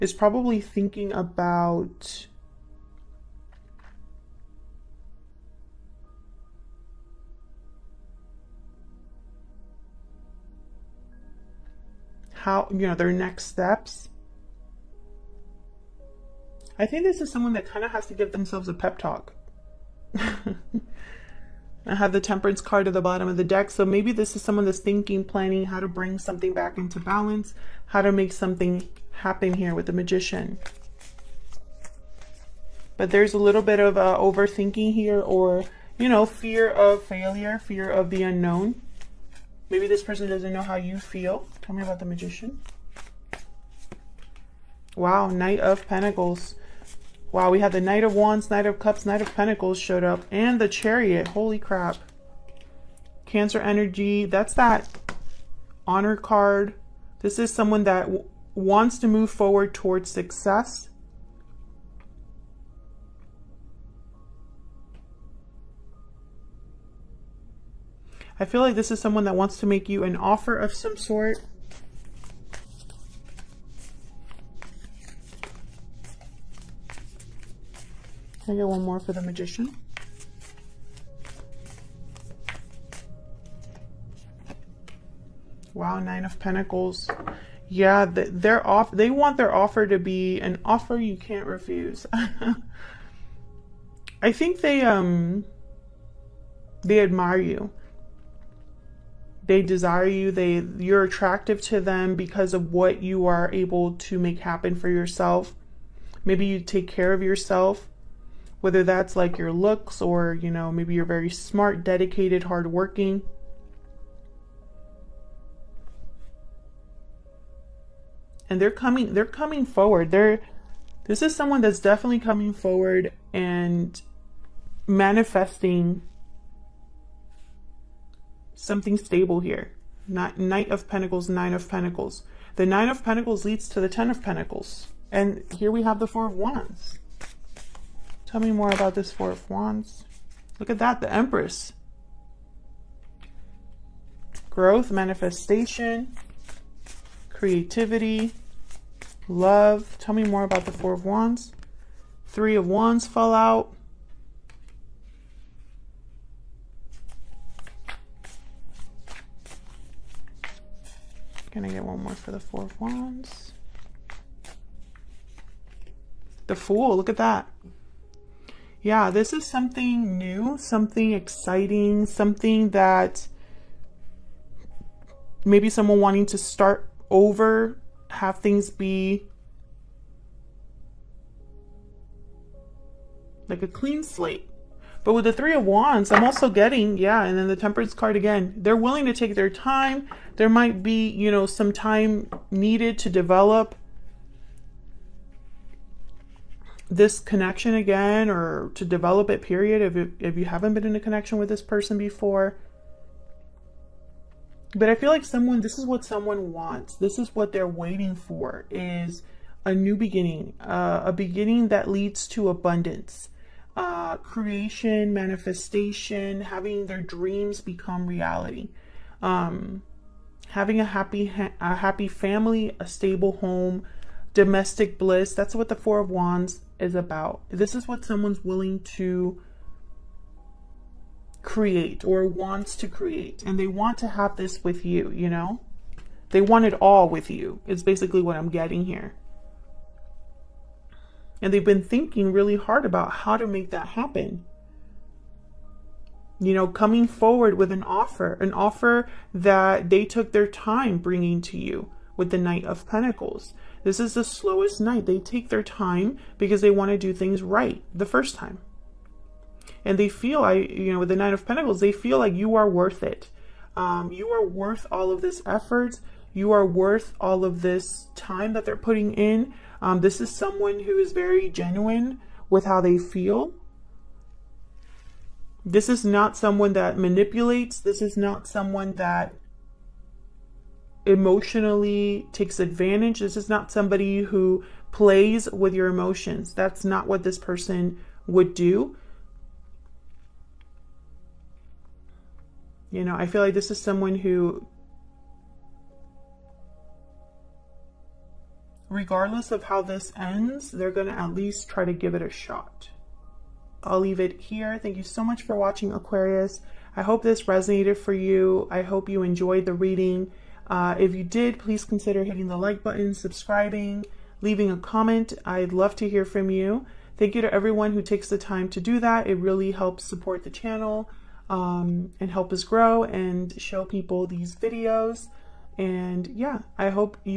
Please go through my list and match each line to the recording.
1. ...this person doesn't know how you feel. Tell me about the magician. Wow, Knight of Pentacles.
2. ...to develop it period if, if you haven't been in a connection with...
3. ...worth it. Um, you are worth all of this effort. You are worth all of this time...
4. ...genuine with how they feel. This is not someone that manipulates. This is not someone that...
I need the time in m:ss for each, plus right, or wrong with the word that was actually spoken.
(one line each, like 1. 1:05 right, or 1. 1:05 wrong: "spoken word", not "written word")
1. 0:39 right
2. 3:18 right
3. 4:22 right
4. 4:31 right.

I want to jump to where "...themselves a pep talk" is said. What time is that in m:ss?
0:18.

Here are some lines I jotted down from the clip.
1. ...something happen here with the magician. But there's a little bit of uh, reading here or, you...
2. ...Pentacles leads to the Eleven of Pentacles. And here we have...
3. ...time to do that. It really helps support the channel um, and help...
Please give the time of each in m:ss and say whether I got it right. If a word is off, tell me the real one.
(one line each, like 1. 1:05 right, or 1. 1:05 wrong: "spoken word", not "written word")
1. 0:28 wrong: "overthinking", not "reading"
2. 2:13 wrong: "Ten", not "Eleven"
3. 5:18 right.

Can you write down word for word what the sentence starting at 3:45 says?
That's what the 4 of wands is about.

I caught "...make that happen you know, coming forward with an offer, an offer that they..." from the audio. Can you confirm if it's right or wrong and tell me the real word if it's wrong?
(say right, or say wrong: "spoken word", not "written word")
right.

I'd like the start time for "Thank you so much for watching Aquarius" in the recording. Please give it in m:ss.
5:04.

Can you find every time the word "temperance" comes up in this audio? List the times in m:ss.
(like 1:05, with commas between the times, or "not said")
0:22, 3:07.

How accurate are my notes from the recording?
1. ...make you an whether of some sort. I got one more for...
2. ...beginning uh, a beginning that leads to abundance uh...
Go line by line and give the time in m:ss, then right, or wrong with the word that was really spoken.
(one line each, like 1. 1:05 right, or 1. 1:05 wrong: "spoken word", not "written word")
1. 1:09 wrong: "offer", not "whether"
2. 3:29 right.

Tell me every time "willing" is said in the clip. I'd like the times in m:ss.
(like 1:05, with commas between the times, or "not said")
3:08, 3:48.